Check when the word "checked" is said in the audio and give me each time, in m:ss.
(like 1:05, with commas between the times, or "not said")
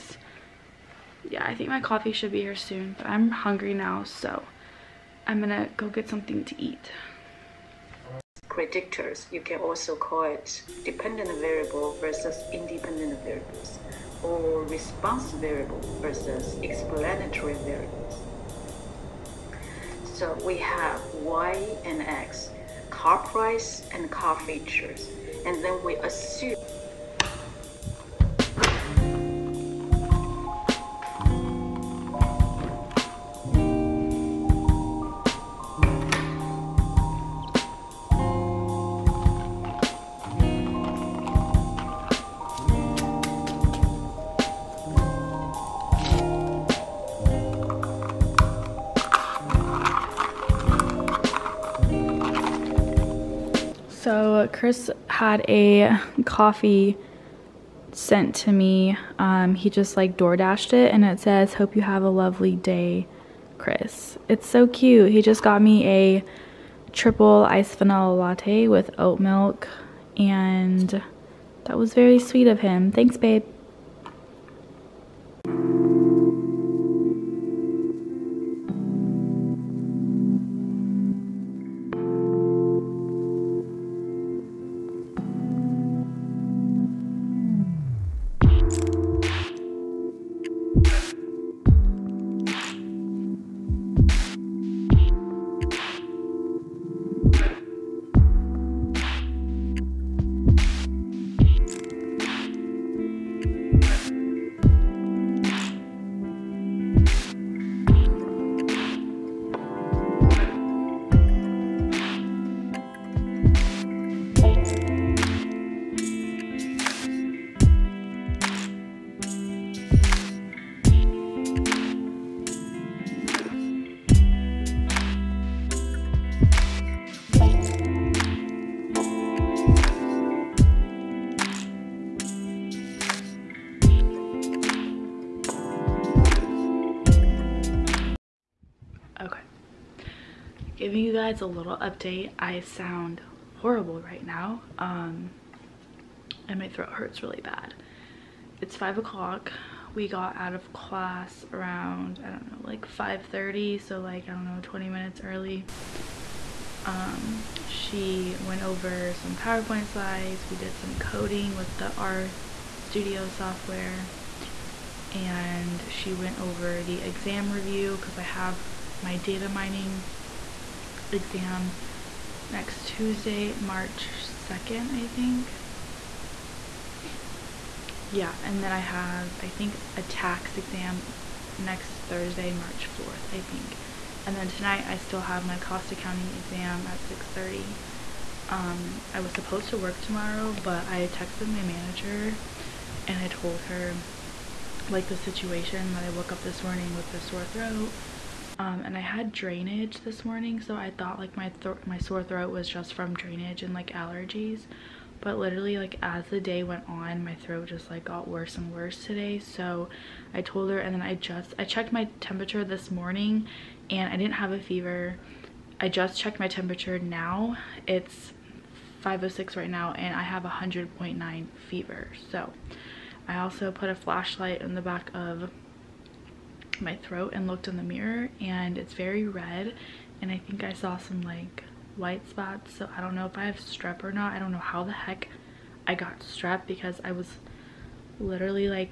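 3:31, 3:36.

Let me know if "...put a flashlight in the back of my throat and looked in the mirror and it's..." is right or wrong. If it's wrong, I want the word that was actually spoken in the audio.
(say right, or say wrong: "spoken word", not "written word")
right.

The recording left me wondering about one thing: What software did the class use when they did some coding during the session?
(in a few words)
R Studio.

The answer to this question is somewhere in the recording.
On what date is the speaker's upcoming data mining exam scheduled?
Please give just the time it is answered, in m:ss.
2:53.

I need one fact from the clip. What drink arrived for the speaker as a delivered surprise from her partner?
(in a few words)
triple iced vanilla latte.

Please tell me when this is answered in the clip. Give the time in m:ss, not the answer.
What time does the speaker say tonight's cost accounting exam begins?
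3:07.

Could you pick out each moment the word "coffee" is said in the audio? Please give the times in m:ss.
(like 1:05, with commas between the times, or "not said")
0:01, 0:56.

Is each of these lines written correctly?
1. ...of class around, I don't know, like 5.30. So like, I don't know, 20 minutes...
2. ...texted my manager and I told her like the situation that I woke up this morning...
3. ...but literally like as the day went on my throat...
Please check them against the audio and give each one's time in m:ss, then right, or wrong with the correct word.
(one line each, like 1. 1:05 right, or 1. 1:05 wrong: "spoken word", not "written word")
1. 2:30 right
2. 3:11 right
3. 3:25 right.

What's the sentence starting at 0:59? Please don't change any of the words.
Um, he just like door dashed it and it says, Hope you have a lovely day, Chris.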